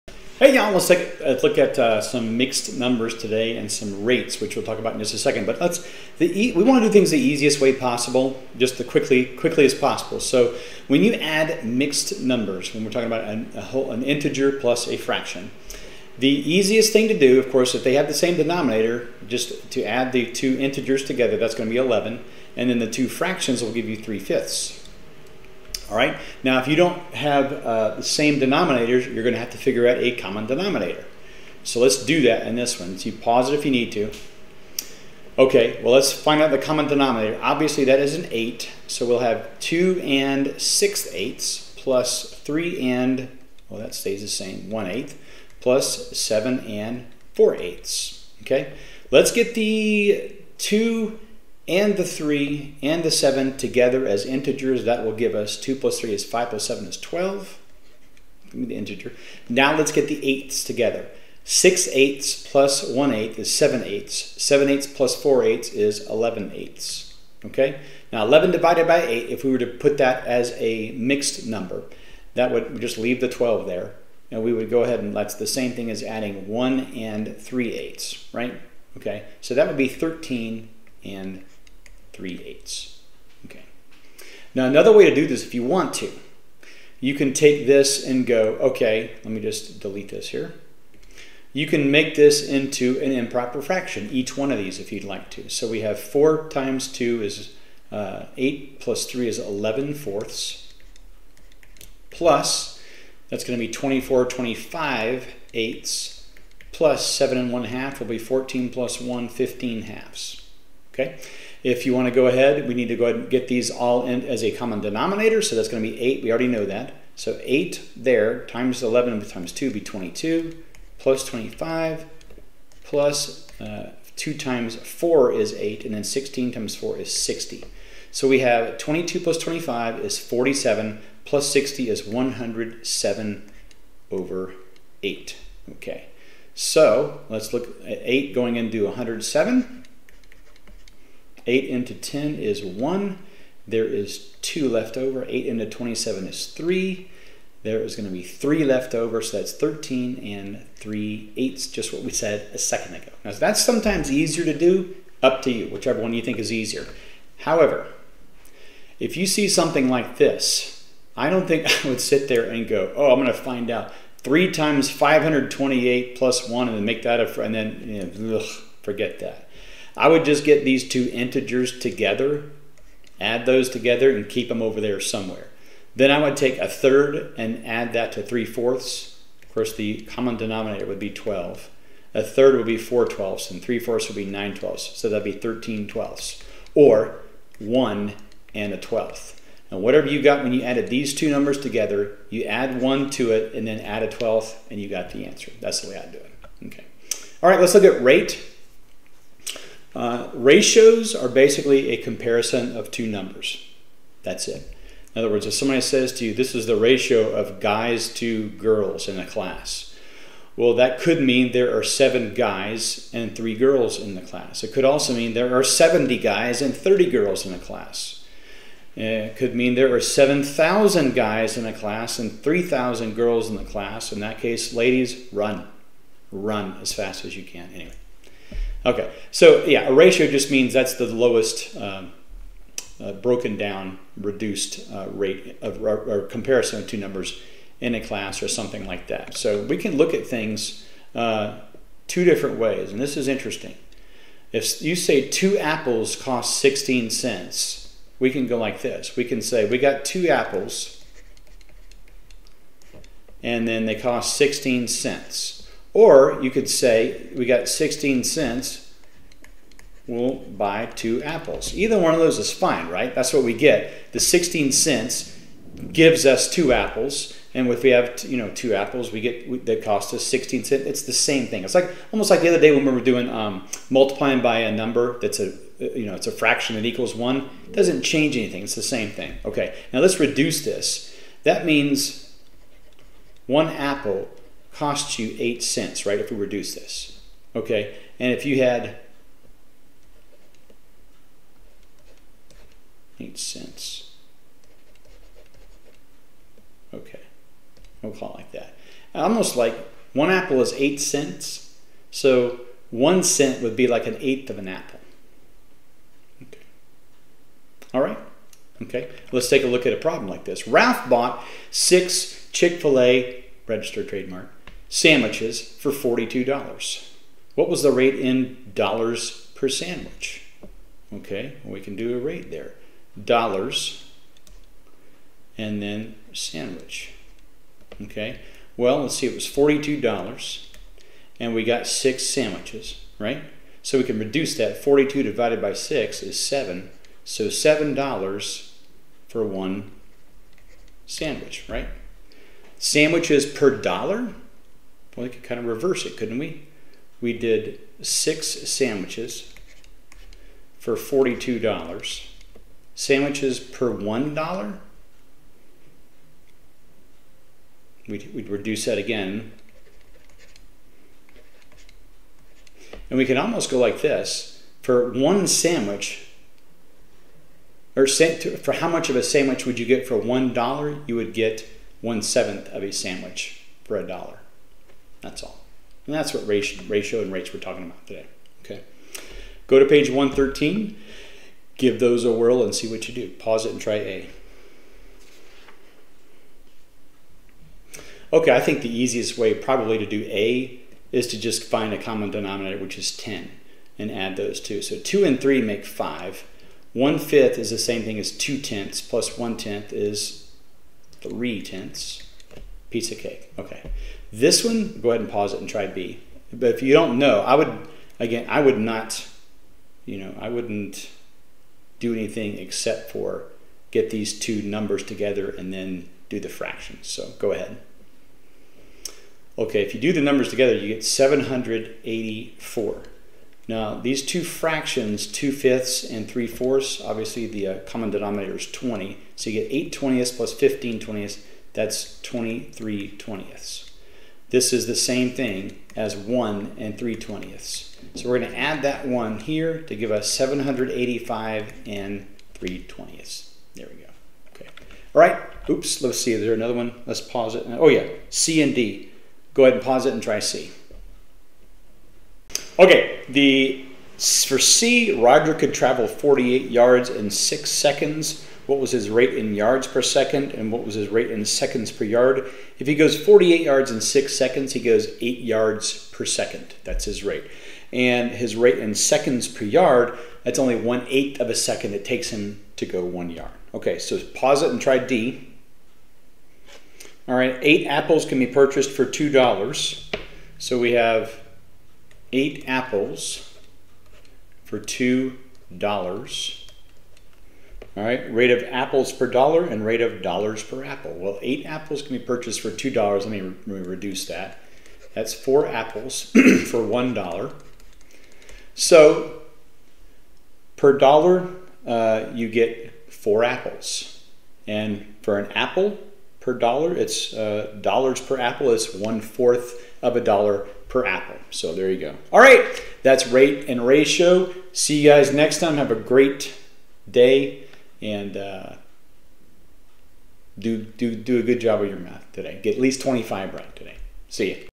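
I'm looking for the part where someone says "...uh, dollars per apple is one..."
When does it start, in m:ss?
8:27.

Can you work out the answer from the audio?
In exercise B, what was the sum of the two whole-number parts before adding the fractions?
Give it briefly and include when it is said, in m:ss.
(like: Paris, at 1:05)
784, at 7:01.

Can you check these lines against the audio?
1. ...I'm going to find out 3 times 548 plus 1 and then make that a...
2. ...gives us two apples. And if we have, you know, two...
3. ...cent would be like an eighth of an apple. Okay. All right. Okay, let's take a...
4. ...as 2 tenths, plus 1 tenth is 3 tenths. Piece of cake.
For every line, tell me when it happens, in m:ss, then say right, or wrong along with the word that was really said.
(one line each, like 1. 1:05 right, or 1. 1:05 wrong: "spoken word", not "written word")
1. 2:43 wrong: "528", not "548"
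2. 4:25 right
3. 5:03 right
4. 6:38 right.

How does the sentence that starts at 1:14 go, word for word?
And we would go ahead and that's the same thing as adding 1 and 3 eighths, right?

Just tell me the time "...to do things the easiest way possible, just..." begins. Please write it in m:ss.
0:06.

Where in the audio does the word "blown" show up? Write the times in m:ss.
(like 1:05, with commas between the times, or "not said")
not said.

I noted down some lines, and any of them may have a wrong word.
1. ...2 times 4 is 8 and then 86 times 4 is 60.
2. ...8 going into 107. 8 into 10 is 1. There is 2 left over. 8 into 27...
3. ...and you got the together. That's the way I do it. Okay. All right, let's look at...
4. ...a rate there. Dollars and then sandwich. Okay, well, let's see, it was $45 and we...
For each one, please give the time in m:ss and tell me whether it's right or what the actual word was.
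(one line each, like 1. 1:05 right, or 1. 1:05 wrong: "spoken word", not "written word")
1. 2:04 wrong: "16", not "86"
2. 2:18 right
3. 3:14 wrong: "answer", not "together"
4. 5:22 wrong: "42", not "45".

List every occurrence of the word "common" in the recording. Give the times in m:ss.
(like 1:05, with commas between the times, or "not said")
0:30, 0:36, 1:54, 3:00, 6:32, 7:07.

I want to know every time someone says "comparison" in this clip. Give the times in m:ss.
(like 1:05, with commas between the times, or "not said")
3:21, 3:56.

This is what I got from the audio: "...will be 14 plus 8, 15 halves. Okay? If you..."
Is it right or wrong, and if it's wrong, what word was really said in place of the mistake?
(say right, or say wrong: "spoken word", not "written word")
wrong: "1", not "8".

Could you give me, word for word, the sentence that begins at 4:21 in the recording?
Either one of those is fine, right?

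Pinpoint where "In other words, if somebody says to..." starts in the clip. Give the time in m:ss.
3:25.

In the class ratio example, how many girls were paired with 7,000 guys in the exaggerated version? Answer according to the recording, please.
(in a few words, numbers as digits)
3,000.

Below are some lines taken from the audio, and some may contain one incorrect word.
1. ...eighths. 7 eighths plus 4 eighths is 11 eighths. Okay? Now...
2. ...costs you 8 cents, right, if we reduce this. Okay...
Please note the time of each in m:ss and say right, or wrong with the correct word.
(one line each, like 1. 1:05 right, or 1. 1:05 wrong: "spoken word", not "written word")
1. 1:03 right
2. 4:44 right.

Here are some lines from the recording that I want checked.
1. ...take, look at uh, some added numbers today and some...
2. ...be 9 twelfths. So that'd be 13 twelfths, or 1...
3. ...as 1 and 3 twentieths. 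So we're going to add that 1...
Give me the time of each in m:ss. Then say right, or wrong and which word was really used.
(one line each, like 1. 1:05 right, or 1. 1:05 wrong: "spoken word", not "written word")
1. 0:00 wrong: "mixed", not "added"
2. 3:04 right
3. 7:15 right.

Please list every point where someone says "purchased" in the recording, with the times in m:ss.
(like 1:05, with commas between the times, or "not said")
7:58, 8:12.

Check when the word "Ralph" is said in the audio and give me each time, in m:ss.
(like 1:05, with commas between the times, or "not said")
5:10.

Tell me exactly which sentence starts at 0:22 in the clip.
And then the two fractions will give you 3 fifths, all right.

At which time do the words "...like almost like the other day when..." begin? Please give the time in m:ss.
4:31.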